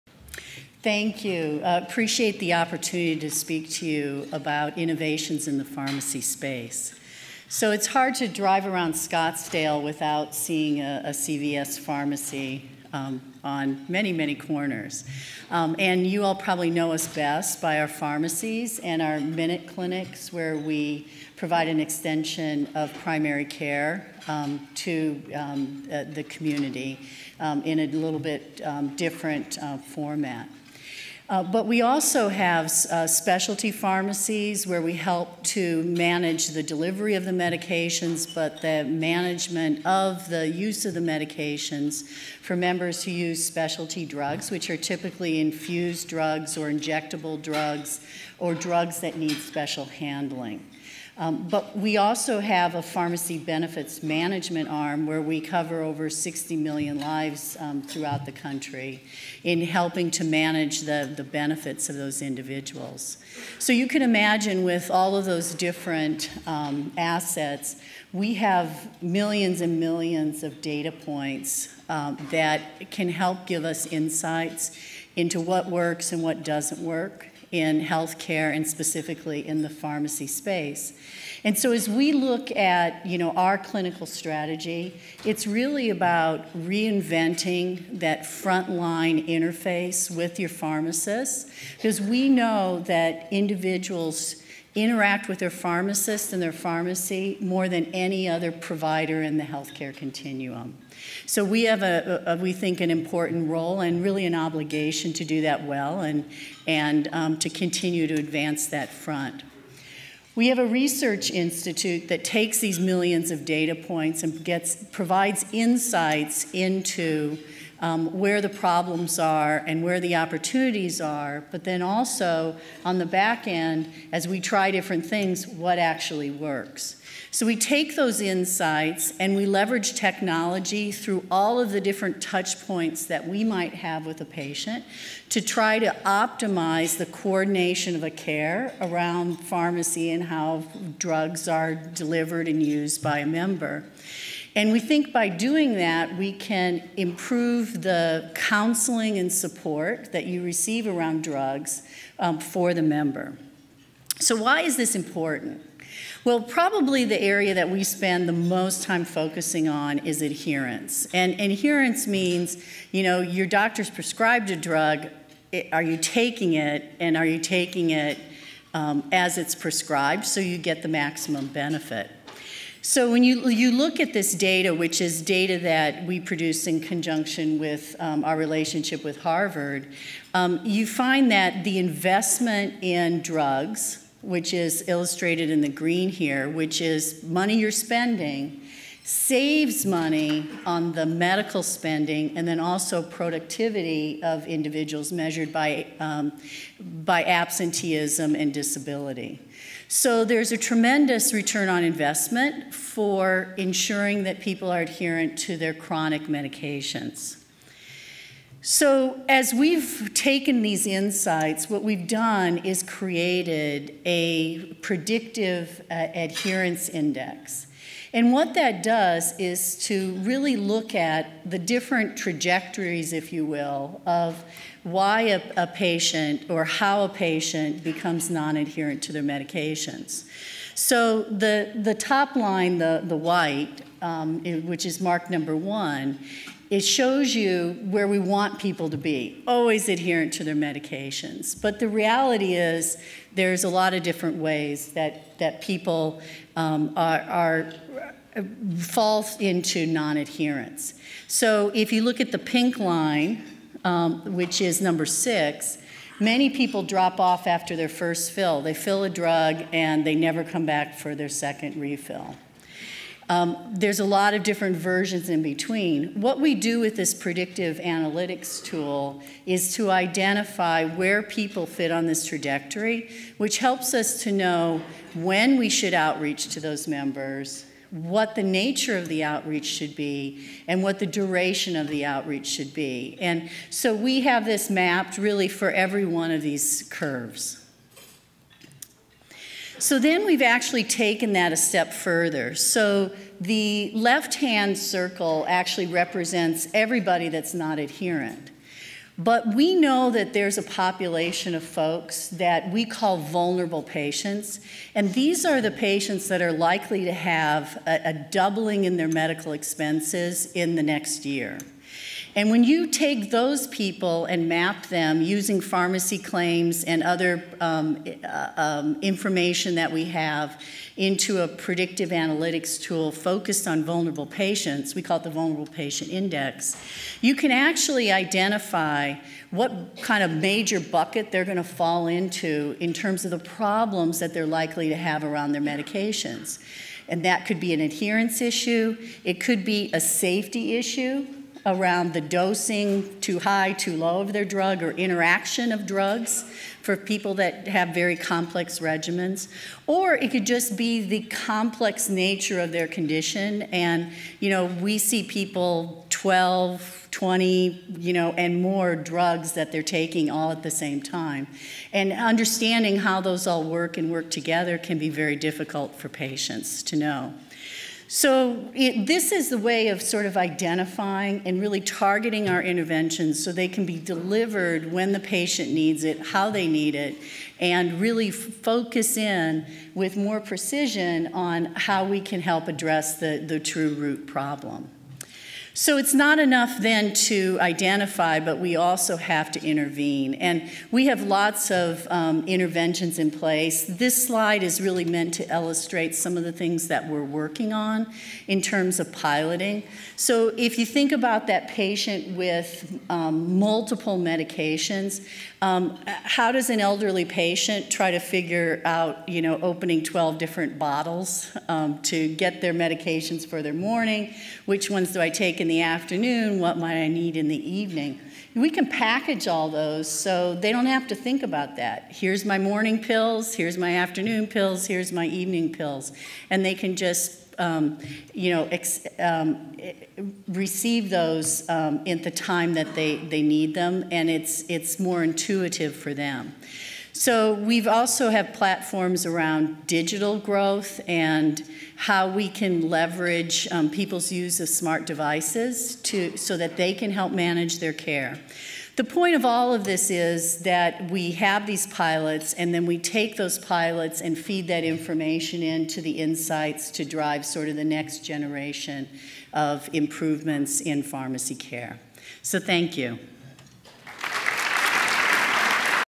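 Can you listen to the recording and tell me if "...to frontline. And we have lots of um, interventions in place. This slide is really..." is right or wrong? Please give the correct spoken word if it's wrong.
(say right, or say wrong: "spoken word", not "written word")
wrong: "intervene", not "frontline".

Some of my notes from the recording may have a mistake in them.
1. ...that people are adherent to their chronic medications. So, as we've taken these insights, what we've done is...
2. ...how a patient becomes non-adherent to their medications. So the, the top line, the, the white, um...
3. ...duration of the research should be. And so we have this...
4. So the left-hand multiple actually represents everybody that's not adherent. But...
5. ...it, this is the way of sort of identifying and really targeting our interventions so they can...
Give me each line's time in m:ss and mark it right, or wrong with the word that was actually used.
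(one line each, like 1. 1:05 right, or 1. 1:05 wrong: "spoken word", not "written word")
1. 3:24 right
2. 3:46 right
3. 4:41 wrong: "outreach", not "research"
4. 4:52 wrong: "circle", not "multiple"
5. 6:08 right.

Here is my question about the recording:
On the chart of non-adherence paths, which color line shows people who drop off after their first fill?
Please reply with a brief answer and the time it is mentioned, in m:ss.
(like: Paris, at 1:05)
pink, at 4:12.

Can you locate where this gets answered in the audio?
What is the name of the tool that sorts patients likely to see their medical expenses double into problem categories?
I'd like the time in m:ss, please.
5:25.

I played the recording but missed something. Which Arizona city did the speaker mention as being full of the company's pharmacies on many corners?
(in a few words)
Scottsdale.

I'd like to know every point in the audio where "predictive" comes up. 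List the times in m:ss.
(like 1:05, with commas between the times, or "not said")
3:34, 4:27, 5:21.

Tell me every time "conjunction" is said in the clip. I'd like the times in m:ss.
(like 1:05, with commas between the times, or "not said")
2:56.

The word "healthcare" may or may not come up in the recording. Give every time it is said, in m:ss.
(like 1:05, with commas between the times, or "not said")
1:17, 1:39.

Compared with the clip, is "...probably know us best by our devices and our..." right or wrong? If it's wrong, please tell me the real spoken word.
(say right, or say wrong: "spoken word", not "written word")
wrong: "pharmacies", not "devices".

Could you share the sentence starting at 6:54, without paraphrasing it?
Which ones do I take in the afternoon?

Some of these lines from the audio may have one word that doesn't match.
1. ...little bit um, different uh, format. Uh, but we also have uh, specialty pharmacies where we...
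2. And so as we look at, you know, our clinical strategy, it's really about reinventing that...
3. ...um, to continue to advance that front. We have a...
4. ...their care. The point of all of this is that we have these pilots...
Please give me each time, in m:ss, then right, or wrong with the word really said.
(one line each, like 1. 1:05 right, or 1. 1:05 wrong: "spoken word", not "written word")
1. 0:27 right
2. 1:21 right
3. 1:47 right
4. 7:27 right.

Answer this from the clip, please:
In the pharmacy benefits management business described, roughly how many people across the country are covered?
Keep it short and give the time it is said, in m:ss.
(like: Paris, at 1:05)
60 million, at 0:55.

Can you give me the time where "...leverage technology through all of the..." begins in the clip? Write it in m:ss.
2:09.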